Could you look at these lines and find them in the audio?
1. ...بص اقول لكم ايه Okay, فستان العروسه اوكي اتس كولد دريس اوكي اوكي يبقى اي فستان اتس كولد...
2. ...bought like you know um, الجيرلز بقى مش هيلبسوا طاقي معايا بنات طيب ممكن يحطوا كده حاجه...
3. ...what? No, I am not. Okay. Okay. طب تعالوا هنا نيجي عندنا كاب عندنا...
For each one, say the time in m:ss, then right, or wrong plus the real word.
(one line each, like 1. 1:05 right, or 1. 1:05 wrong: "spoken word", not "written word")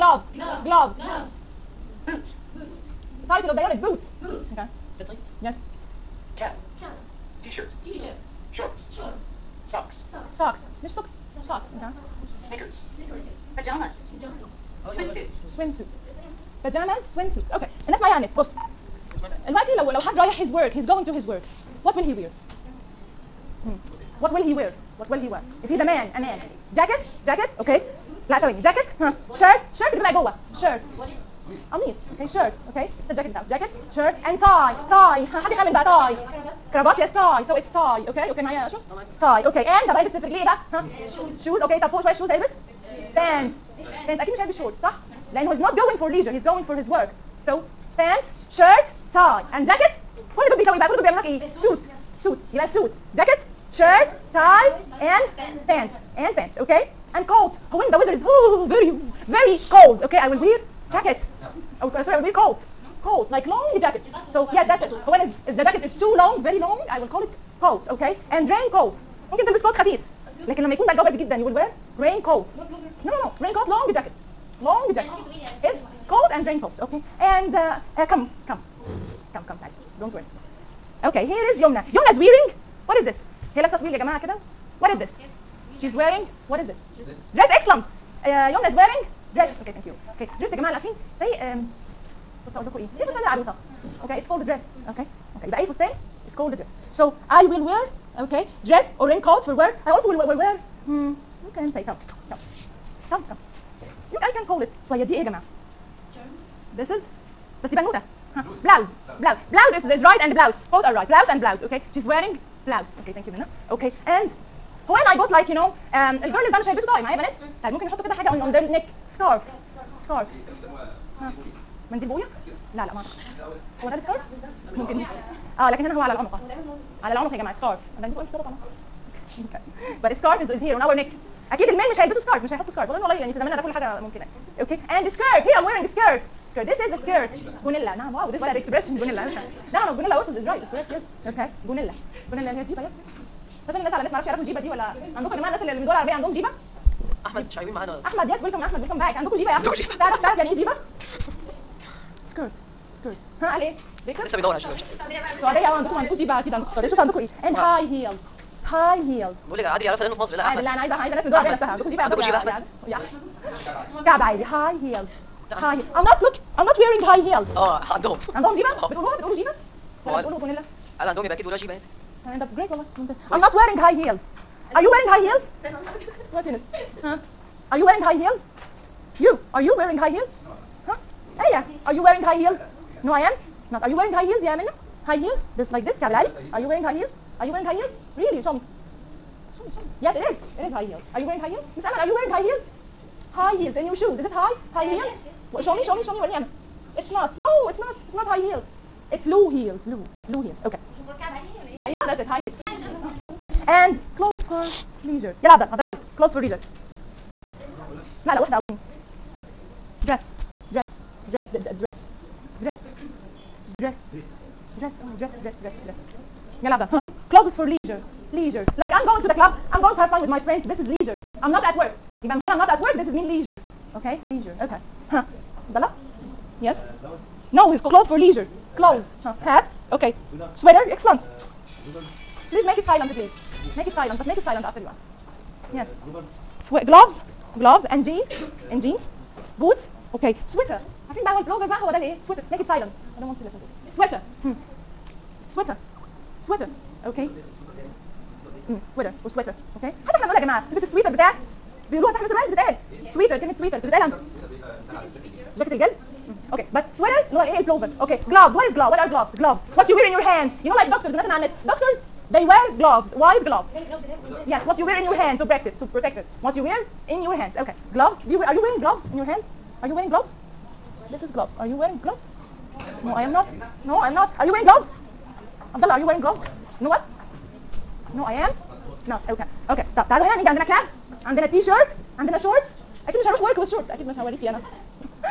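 1. 1:32 right
2. 1:55 right
3. 4:36 right.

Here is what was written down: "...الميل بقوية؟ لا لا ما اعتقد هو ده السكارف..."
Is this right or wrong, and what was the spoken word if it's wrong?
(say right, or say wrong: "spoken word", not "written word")
wrong: "منديل", not "الميل".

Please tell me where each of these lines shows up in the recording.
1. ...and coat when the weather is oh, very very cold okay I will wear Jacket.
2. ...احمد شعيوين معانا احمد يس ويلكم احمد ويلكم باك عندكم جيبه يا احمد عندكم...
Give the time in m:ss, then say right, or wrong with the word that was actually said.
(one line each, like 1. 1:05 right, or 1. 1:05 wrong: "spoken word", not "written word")
1. 0:57 right
2. 2:27 right.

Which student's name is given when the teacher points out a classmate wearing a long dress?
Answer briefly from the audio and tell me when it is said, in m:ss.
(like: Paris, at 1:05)
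Yomna, at 1:21.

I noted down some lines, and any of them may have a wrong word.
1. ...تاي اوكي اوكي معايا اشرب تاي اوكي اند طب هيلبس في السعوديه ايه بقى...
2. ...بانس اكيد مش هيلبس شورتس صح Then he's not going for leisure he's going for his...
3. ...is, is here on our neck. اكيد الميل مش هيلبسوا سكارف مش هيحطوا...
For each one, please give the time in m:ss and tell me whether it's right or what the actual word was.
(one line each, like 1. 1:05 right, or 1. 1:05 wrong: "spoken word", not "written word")
1. 0:37 wrong: "رجليه", not "السعوديه"
2. 0:44 right
3. 2:10 right.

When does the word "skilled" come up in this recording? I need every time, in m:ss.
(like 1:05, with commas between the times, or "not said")
not said.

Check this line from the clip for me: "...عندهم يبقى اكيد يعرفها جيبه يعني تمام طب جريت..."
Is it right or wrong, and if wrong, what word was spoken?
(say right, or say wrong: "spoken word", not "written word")
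wrong: "بيقولوها", not "يعرفها".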